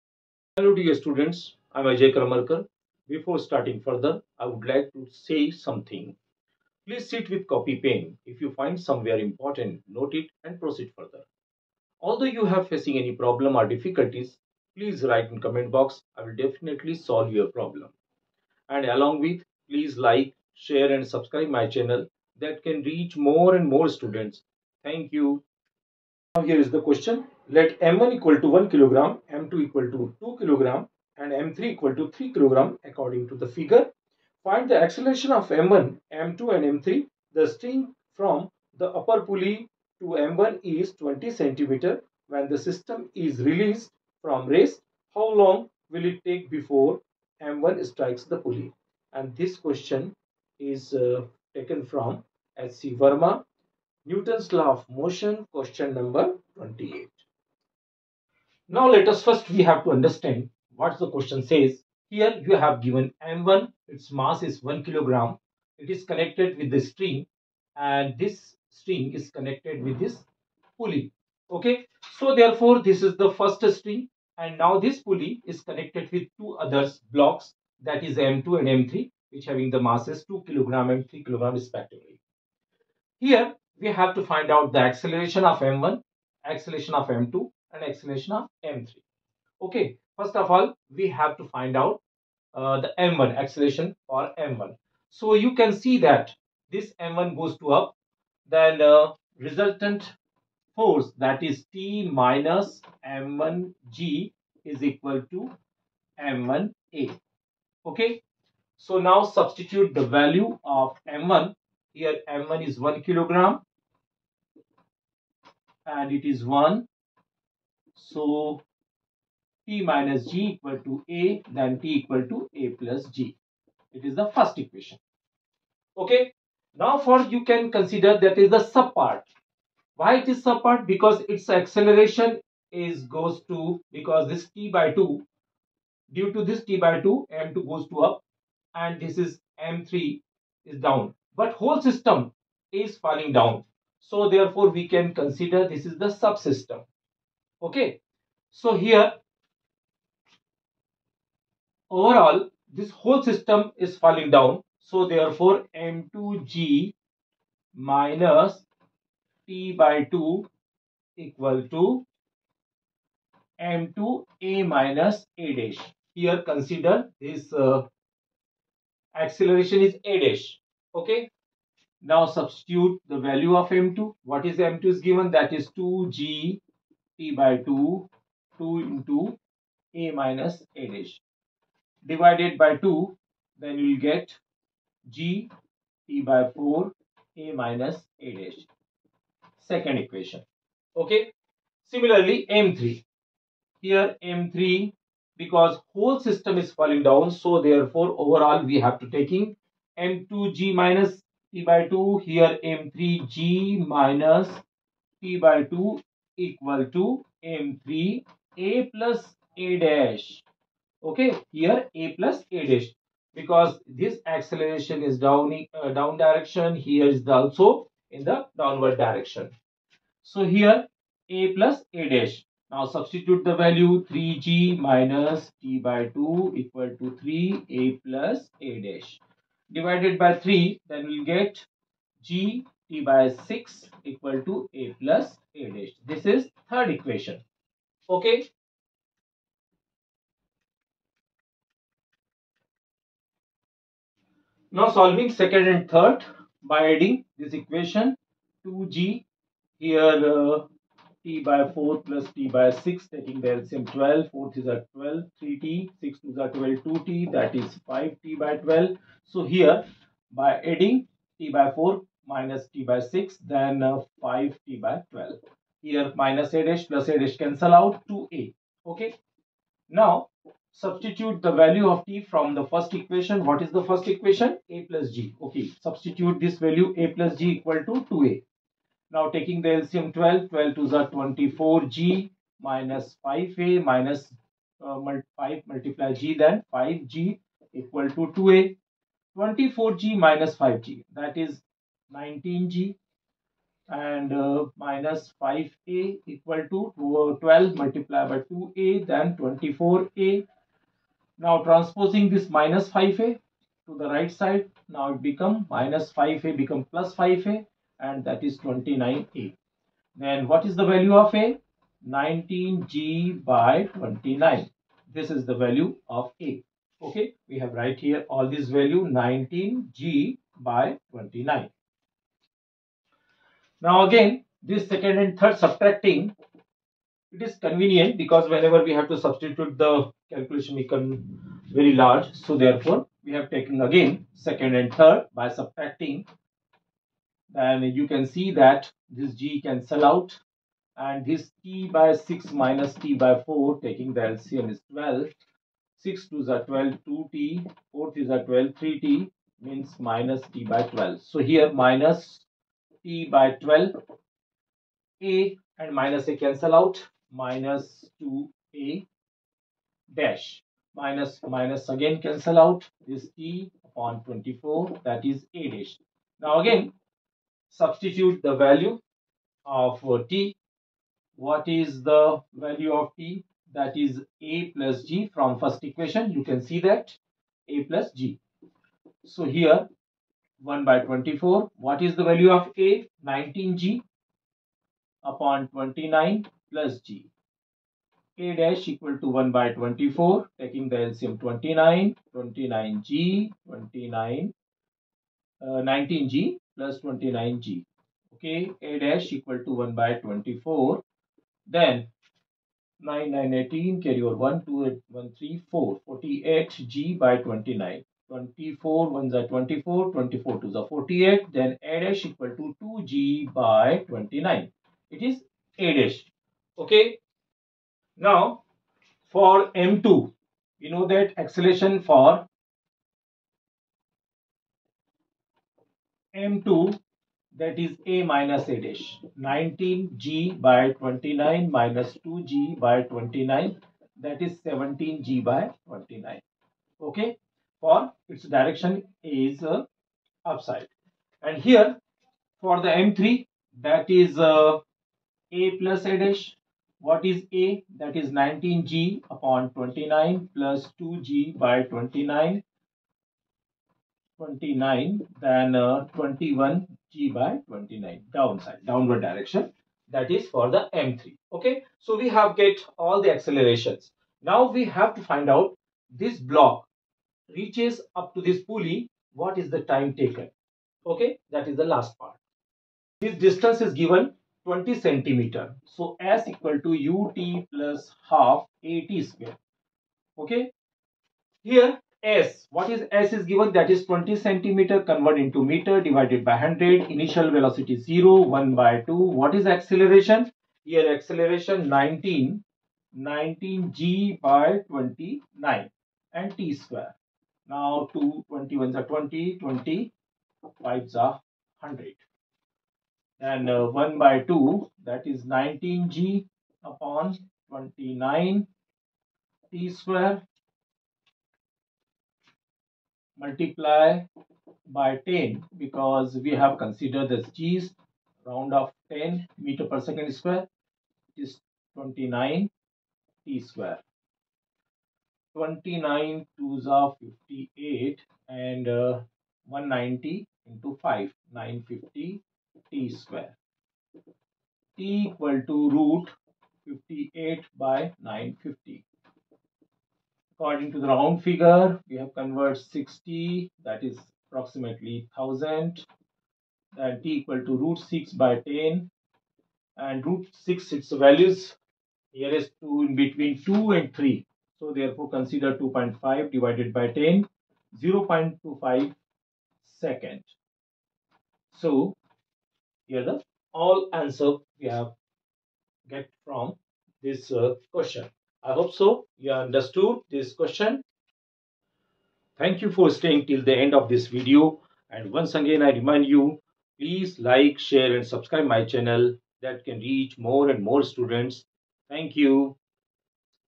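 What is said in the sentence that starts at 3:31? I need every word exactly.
Okay, here A plus A dash because this acceleration is down, uh, down direction.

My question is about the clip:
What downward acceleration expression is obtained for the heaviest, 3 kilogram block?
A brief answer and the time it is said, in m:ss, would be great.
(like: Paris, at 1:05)
21g/29, at 7:36.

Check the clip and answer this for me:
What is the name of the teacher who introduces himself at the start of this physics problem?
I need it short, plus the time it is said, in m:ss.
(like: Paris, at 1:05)
Ajay Karmarkar, at 0:01.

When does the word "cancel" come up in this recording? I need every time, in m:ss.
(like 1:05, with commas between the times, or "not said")
4:27, 5:39, 5:56, 6:02.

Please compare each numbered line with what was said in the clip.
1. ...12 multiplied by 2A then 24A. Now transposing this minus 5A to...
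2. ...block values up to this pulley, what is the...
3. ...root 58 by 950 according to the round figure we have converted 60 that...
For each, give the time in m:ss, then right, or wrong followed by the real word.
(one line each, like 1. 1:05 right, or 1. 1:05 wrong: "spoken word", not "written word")
1. 4:57 right
2. 7:46 wrong: "reaches", not "values"
3. 8:55 right.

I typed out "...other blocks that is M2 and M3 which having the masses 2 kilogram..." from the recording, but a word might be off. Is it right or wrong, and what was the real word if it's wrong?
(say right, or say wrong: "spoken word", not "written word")
right.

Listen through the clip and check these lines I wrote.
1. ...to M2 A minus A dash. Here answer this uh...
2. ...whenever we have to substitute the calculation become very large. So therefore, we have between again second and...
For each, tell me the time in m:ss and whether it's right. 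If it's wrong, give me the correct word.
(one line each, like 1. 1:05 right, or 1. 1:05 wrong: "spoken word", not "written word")
1. 2:41 wrong: "consider", not "answer"
2. 5:28 wrong: "taken", not "between".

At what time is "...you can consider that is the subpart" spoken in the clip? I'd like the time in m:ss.
2:07.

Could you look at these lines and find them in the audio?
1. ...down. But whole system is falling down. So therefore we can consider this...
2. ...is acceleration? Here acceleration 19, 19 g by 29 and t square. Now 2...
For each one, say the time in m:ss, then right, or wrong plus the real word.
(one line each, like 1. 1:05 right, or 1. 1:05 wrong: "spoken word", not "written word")
1. 2:20 right
2. 8:09 right.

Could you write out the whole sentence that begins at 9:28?
I hope so you understood this question.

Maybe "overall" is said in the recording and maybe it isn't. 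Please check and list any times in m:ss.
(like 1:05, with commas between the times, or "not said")
2:31, 3:18.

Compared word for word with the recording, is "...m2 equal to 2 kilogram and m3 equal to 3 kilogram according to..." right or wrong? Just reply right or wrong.
right.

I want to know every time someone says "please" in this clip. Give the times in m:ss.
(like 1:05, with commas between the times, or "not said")
0:06, 0:14, 0:19, 9:36.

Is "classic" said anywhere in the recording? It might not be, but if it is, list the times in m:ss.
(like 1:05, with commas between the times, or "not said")
not said.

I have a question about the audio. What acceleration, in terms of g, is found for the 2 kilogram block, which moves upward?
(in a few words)
17g/29.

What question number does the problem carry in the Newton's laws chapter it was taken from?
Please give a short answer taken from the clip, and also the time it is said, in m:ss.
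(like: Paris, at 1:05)
28, at 0:55.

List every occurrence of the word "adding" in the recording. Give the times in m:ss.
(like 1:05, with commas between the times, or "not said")
4:06, 4:20.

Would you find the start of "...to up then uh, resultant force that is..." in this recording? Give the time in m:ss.
1:37.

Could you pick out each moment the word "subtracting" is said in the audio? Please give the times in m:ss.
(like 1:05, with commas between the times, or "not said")
5:25, 5:35.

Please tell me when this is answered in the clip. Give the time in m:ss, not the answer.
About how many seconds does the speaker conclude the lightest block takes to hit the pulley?
9:18.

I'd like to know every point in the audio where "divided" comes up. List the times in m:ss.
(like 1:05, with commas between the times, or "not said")
3:02, 3:49, 8:06, 9:16.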